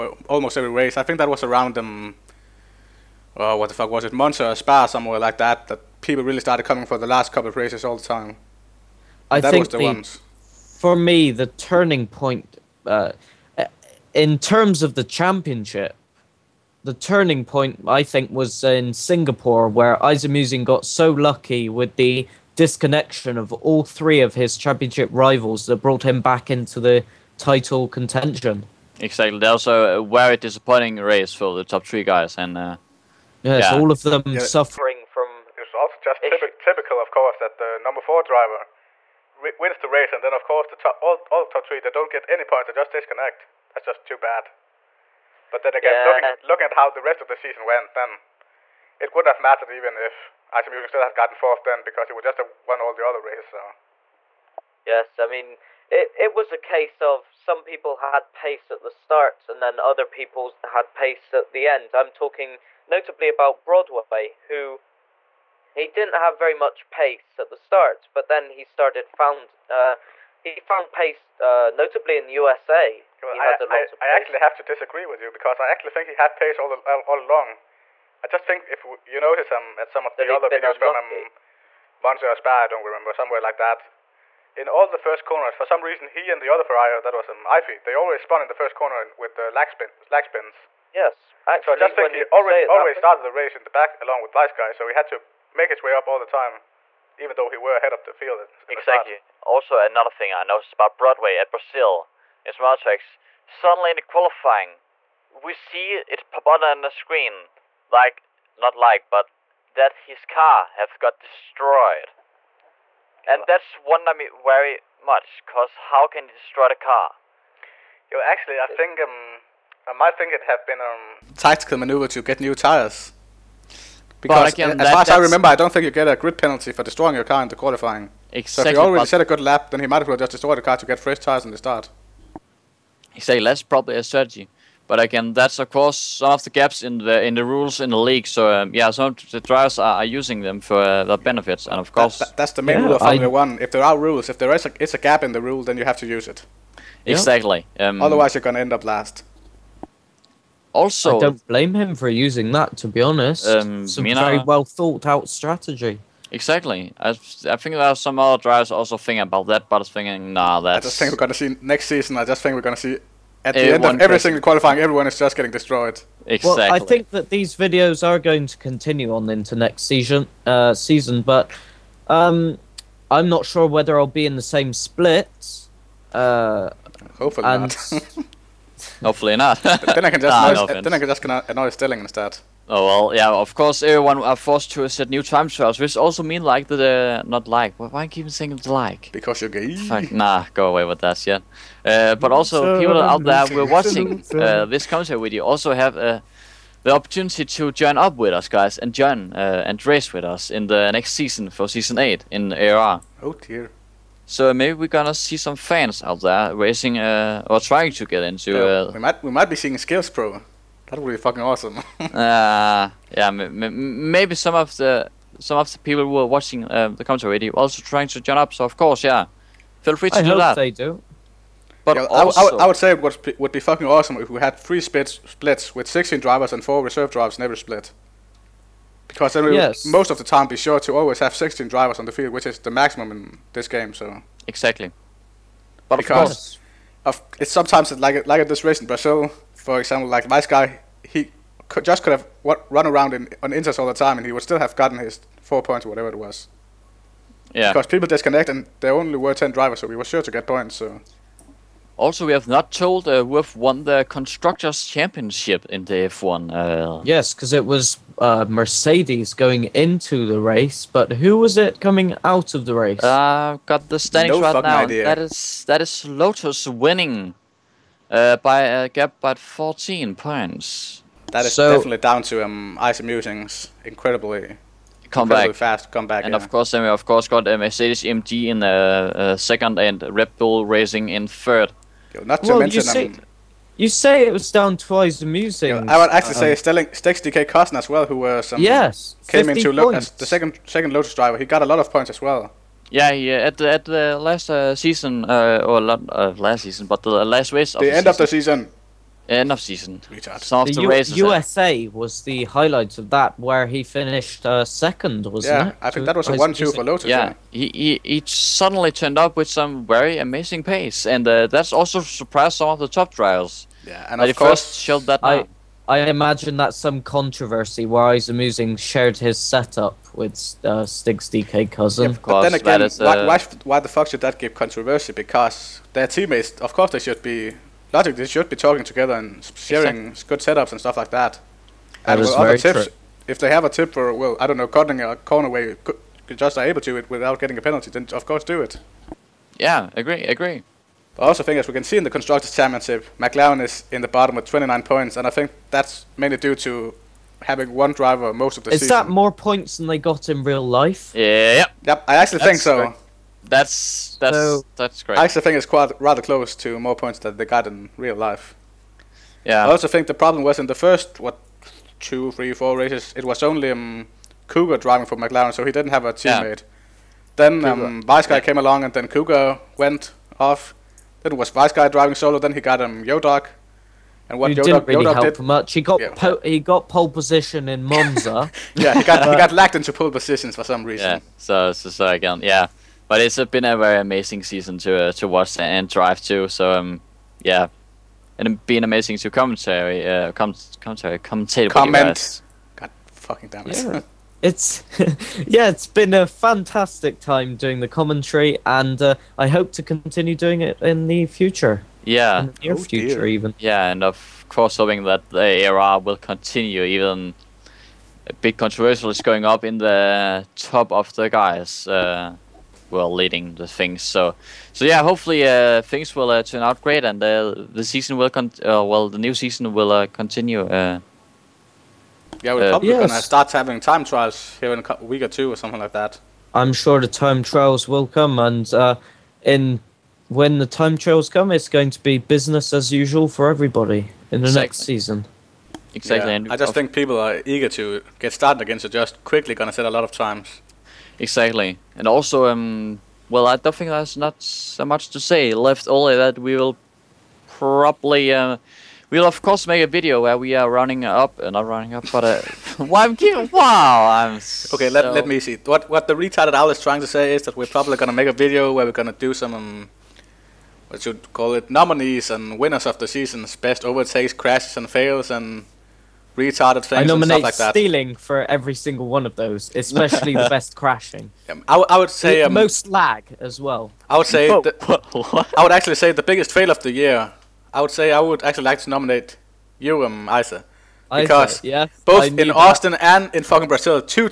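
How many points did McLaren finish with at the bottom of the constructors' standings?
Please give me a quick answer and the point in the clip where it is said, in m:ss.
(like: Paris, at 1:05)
29, at 5:44.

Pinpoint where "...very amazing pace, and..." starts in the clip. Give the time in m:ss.
5:09.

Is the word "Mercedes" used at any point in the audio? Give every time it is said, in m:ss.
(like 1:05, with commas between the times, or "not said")
4:18, 4:37.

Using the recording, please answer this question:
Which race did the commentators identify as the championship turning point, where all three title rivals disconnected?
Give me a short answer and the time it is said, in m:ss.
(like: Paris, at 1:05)
Singapore, at 0:18.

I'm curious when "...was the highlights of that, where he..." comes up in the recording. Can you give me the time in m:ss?
5:01.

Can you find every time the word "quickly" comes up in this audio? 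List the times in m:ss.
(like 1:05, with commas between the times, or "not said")
7:19.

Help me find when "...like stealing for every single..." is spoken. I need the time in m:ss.
7:47.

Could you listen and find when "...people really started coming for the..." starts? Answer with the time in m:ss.
0:06.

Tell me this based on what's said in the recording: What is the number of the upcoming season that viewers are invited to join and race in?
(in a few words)
8.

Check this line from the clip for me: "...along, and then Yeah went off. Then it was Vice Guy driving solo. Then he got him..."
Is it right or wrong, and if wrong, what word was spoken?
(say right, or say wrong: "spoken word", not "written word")
wrong: "Cougar", not "Yeah".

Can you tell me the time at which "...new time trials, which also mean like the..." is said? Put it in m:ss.
3:05.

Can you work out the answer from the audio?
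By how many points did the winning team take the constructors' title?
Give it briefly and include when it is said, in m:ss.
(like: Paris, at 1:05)
14, at 4:29.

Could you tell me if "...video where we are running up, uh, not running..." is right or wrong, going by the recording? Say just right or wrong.
right.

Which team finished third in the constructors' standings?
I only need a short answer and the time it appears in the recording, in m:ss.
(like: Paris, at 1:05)
Red Bull Racing, at 4:40.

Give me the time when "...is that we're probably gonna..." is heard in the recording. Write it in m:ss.
7:37.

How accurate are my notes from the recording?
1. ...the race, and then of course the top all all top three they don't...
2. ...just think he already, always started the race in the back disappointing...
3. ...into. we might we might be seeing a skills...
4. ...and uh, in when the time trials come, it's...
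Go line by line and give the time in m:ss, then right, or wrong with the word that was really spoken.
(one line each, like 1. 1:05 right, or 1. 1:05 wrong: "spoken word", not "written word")
1. 0:39 right
2. 1:31 wrong: "along", not "disappointing"
3. 3:28 right
4. 7:08 right.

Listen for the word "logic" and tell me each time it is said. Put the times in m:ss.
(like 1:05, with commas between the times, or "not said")
5:27.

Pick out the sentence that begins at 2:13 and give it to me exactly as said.
He say That's probably a strategy.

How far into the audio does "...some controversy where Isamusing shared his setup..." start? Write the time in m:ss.
5:16.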